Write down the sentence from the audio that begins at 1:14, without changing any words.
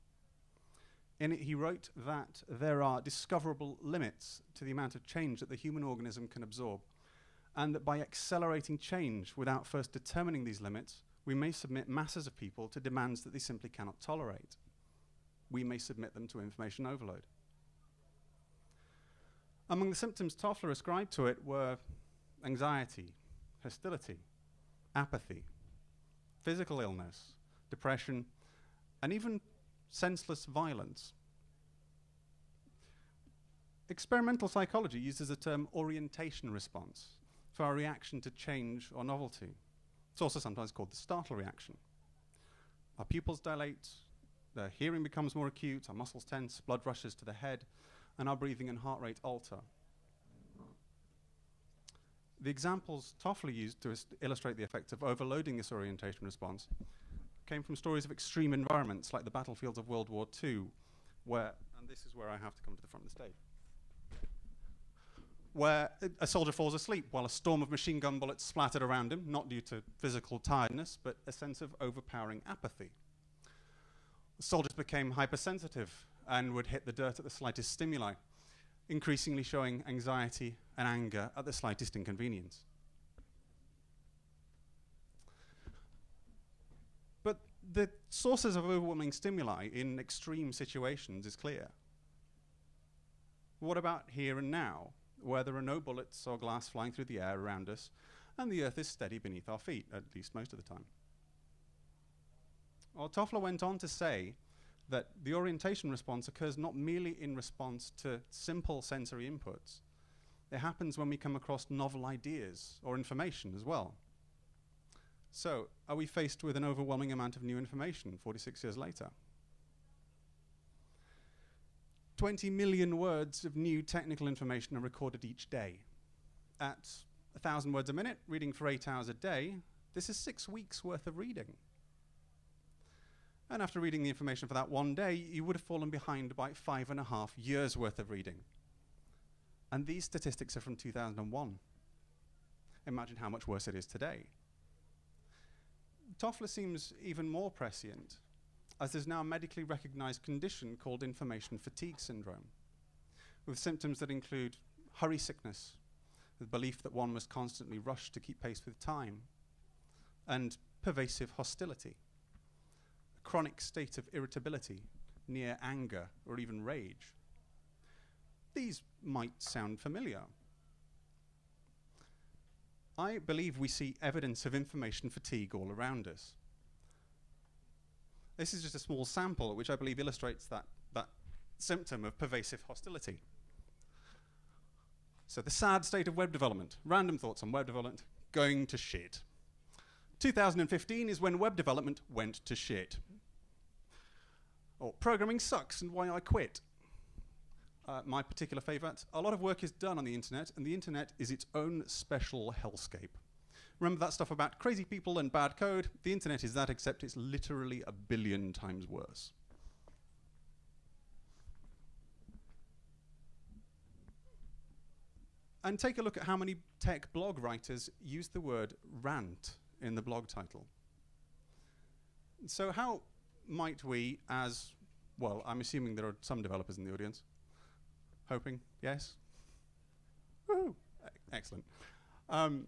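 soldiers became hypersensitive and would hit the dirt at the slightest stimuli, increasingly showing anxiety and anger at the slightest inconvenience.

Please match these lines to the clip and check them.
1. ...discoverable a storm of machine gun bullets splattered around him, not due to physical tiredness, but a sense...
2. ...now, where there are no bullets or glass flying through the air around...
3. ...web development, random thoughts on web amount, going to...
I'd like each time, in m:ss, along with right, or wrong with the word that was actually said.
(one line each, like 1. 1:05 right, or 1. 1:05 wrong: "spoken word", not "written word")
1. 1:07 wrong: "while", not "discoverable"
2. 1:34 right
3. 3:06 wrong: "development", not "amount".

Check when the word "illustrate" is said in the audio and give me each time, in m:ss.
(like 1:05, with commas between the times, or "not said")
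0:54, 2:59.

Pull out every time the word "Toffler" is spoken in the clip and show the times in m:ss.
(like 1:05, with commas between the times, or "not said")
0:20, 0:53, 1:43, 2:26.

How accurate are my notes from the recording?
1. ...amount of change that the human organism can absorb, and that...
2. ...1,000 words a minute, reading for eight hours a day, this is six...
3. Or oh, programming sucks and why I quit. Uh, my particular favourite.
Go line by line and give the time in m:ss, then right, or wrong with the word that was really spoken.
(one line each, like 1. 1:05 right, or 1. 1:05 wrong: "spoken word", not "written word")
1. 0:04 right
2. 2:07 right
3. 3:14 right.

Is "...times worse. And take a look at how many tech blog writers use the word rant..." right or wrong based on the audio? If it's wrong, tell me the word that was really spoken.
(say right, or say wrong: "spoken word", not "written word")
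right.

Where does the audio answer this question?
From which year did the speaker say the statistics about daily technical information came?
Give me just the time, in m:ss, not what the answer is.
2:20.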